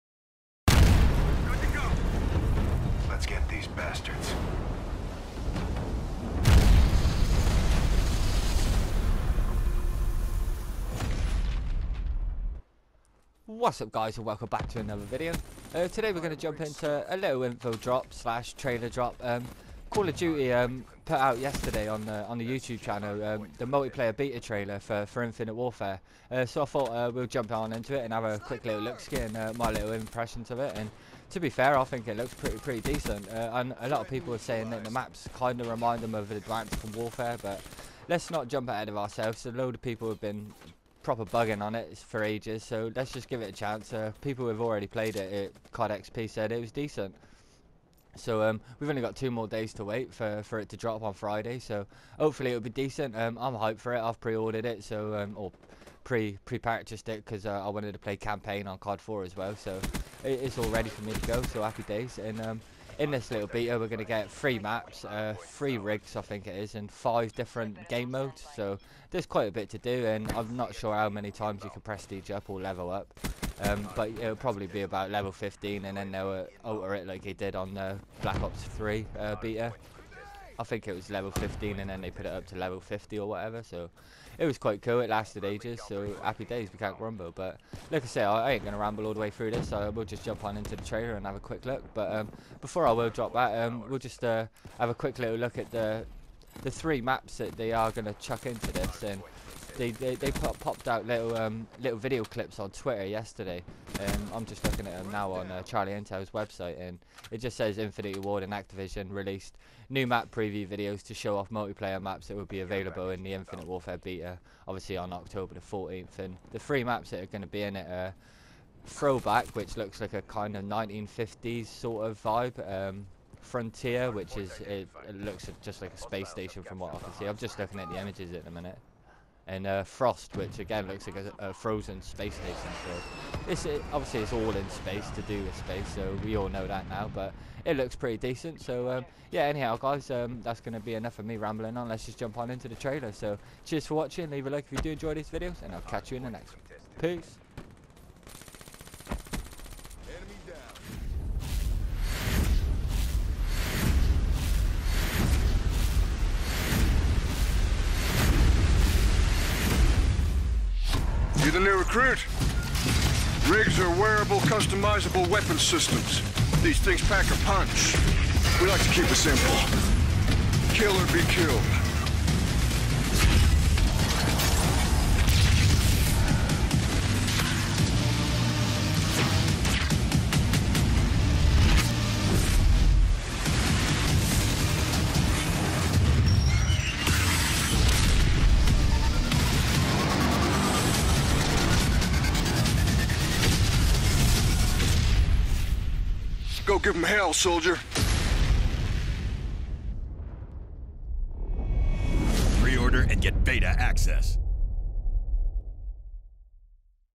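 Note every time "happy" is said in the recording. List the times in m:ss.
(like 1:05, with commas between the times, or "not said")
1:01, 1:26.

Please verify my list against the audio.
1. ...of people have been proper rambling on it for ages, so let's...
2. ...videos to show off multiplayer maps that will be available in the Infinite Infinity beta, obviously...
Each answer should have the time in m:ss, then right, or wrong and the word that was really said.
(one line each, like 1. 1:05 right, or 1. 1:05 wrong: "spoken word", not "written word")
1. 0:39 wrong: "bugging", not "rambling"
2. 1:50 wrong: "Warfare", not "Infinity".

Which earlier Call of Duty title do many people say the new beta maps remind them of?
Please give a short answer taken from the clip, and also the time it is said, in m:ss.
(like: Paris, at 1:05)
Advanced Warfare, at 0:36.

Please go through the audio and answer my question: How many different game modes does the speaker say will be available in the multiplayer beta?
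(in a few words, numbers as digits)
5.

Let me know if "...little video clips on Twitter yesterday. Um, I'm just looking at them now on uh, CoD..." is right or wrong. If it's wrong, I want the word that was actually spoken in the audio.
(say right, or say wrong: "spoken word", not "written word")
wrong: "Charlie", not "CoD".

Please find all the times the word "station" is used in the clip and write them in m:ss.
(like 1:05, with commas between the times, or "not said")
2:06, 2:12.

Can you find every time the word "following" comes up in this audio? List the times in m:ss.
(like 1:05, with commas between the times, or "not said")
not said.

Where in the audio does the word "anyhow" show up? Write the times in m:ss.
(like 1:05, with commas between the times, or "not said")
2:19.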